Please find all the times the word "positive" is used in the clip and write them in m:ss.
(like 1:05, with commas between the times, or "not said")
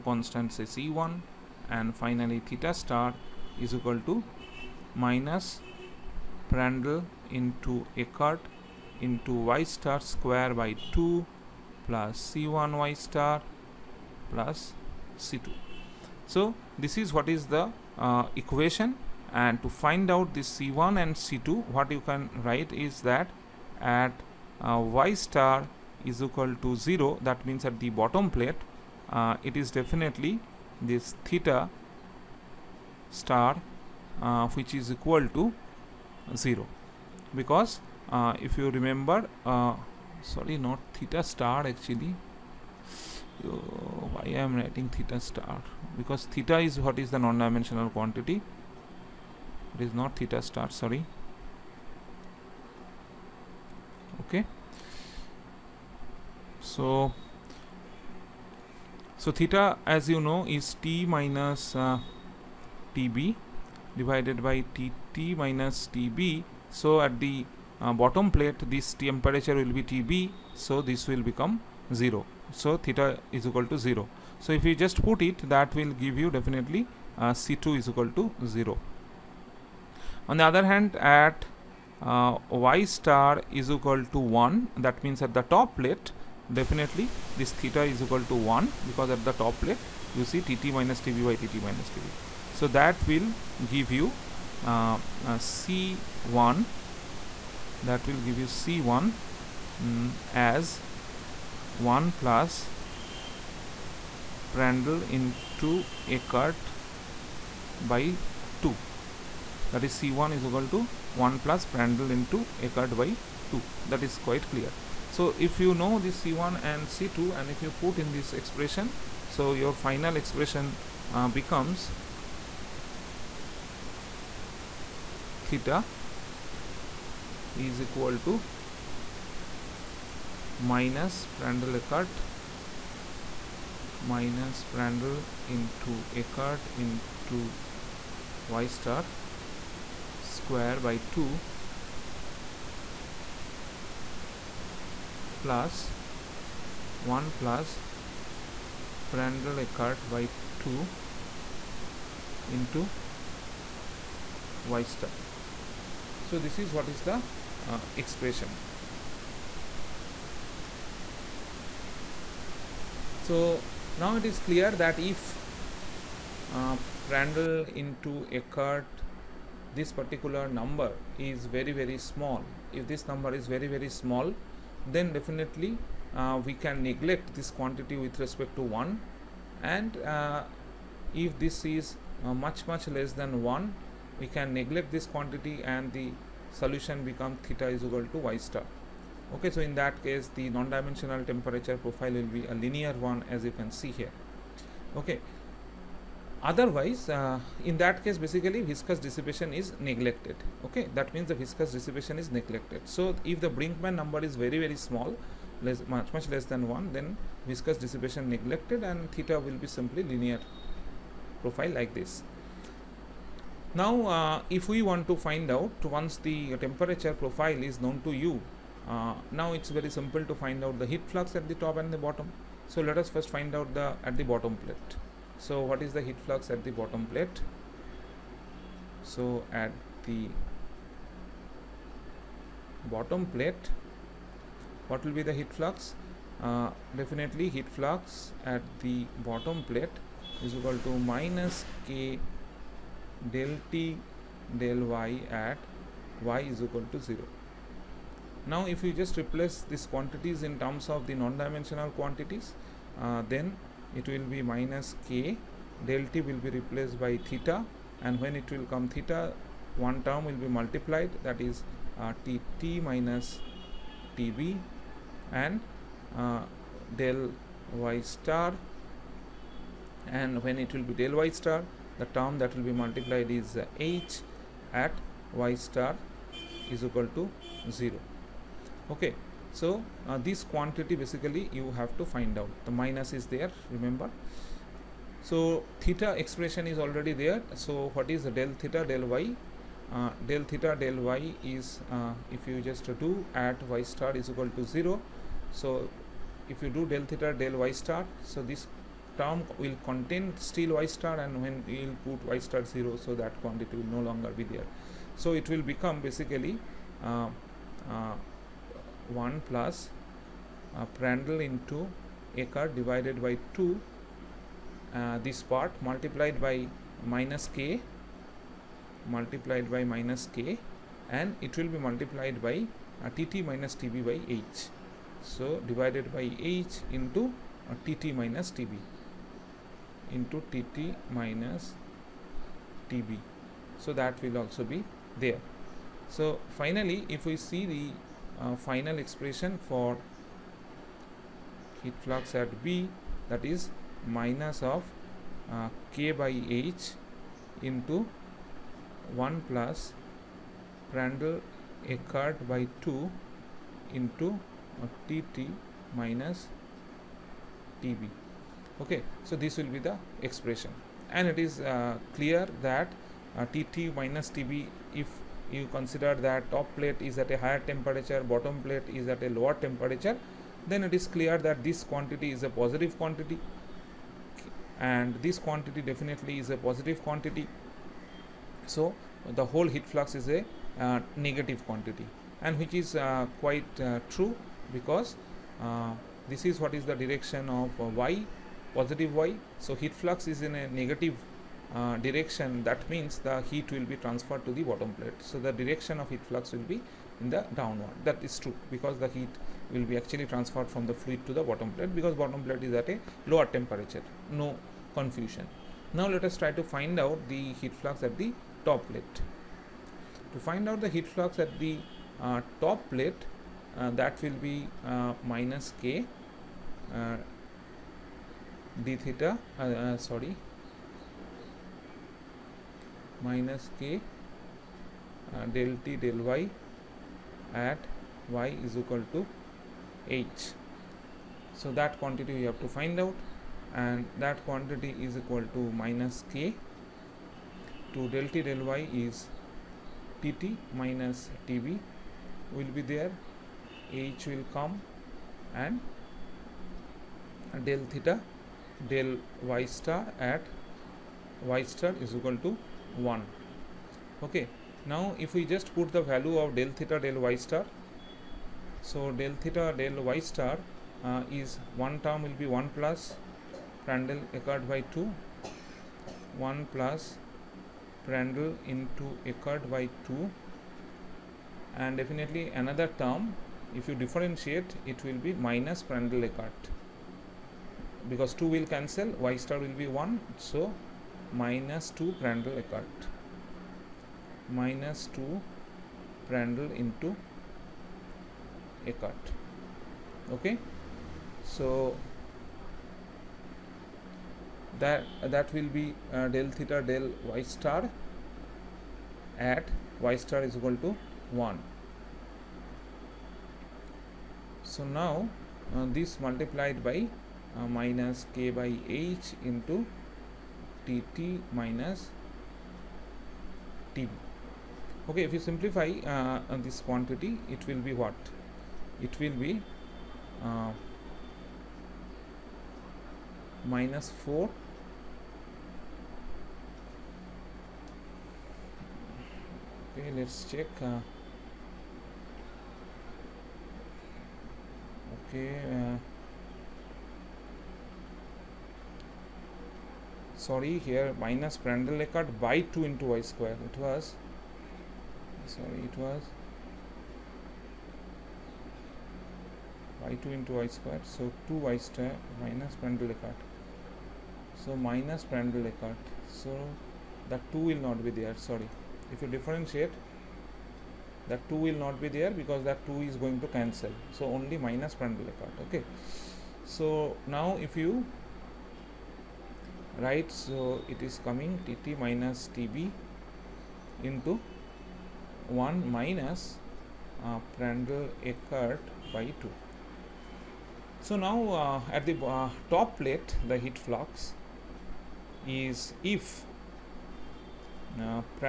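6:12, 6:16, 6:28.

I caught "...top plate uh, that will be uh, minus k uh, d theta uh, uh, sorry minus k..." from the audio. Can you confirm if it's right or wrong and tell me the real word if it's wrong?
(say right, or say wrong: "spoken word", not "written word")
right.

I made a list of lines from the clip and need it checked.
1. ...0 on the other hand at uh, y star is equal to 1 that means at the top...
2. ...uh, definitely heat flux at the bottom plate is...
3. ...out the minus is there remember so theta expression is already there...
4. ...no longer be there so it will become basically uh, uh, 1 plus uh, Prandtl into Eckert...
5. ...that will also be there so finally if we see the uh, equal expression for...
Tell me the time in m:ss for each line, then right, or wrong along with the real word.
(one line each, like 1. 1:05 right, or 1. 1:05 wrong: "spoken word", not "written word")
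1. 1:18 right
2. 3:56 right
3. 4:42 right
4. 5:03 right
5. 5:33 wrong: "final", not "equal".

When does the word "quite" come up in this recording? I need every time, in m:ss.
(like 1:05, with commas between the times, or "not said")
1:54, 6:23.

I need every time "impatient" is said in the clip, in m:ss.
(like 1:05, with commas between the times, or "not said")
not said.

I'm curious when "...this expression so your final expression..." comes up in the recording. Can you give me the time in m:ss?
1:58.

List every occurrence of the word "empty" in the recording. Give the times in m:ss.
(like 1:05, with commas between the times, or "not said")
not said.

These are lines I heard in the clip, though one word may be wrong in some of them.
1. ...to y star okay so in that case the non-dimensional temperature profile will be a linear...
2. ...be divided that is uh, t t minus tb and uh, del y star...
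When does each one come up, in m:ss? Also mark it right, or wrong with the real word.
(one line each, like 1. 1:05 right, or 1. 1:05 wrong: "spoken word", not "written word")
1. 3:08 right
2. 4:20 wrong: "multiplied", not "divided".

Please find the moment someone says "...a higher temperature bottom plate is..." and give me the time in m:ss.
6:07.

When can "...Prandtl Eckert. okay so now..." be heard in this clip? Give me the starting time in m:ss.
9:25.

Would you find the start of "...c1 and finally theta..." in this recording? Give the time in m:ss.
0:00.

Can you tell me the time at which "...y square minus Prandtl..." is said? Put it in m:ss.
9:11.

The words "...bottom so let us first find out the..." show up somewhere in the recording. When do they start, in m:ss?
3:41.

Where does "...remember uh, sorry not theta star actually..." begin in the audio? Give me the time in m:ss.
0:38.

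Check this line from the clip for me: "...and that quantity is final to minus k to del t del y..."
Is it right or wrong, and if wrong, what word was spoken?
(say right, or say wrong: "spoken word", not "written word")
wrong: "equal", not "final".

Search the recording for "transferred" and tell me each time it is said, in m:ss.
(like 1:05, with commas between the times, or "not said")
6:34, 6:40.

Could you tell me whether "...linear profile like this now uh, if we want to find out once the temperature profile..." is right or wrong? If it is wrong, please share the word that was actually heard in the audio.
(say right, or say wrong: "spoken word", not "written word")
right.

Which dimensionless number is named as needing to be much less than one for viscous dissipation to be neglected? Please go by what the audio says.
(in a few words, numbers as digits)
Brinkman number.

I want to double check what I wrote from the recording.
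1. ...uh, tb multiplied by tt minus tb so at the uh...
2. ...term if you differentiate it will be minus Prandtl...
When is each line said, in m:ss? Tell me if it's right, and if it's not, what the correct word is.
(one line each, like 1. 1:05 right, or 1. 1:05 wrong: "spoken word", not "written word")
1. 1:01 wrong: "divided", not "multiplied"
2. 7:53 right.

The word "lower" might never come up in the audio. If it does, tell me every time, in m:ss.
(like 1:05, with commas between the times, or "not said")
6:09, 6:43.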